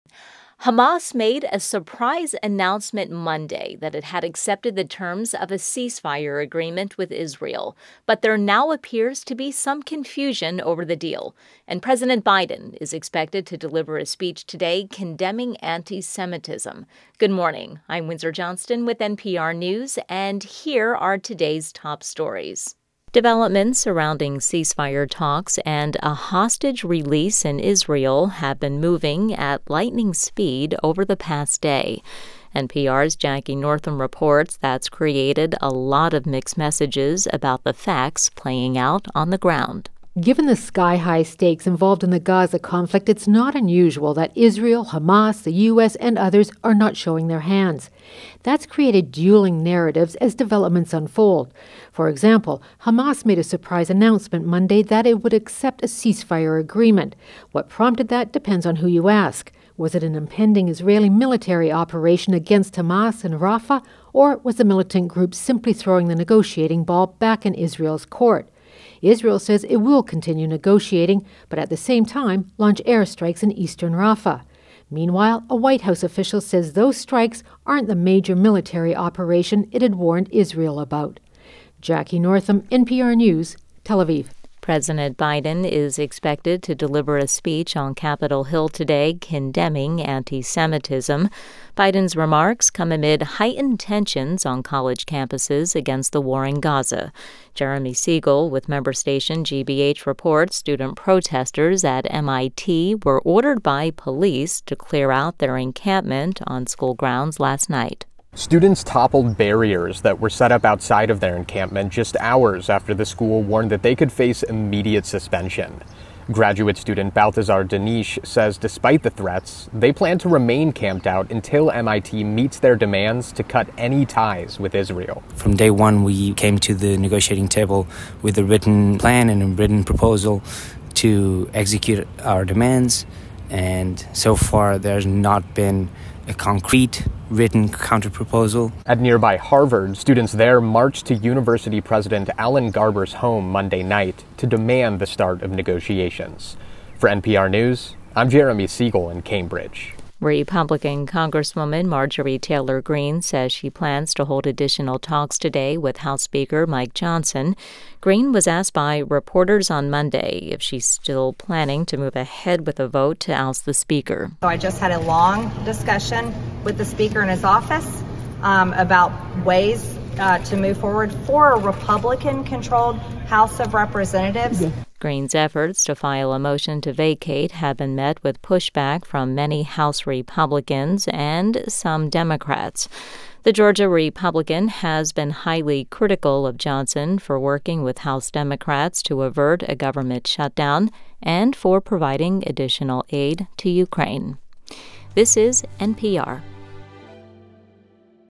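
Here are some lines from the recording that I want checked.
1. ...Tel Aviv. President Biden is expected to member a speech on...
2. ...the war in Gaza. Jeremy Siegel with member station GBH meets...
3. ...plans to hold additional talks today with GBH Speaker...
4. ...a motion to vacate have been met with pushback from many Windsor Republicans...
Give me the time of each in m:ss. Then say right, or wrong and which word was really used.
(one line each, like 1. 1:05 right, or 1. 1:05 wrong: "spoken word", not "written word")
1. 1:23 wrong: "deliver", not "member"
2. 1:36 wrong: "reports", not "meets"
3. 2:33 wrong: "House", not "GBH"
4. 2:56 wrong: "House", not "Windsor".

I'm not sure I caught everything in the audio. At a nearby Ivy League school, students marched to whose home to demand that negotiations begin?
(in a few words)
Alan Garber.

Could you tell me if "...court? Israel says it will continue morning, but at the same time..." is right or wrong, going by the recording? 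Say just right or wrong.
wrong.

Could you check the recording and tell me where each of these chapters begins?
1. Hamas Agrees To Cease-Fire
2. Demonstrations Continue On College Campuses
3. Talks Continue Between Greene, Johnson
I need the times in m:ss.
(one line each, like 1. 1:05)
1. 0:23
2. 1:24
3. 2:30.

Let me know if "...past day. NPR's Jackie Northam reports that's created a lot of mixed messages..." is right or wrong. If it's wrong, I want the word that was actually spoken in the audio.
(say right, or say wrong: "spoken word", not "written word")
right.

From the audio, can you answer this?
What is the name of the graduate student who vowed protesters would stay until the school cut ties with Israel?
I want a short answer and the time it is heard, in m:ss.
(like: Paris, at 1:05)
Balthazar Denish, at 1:57.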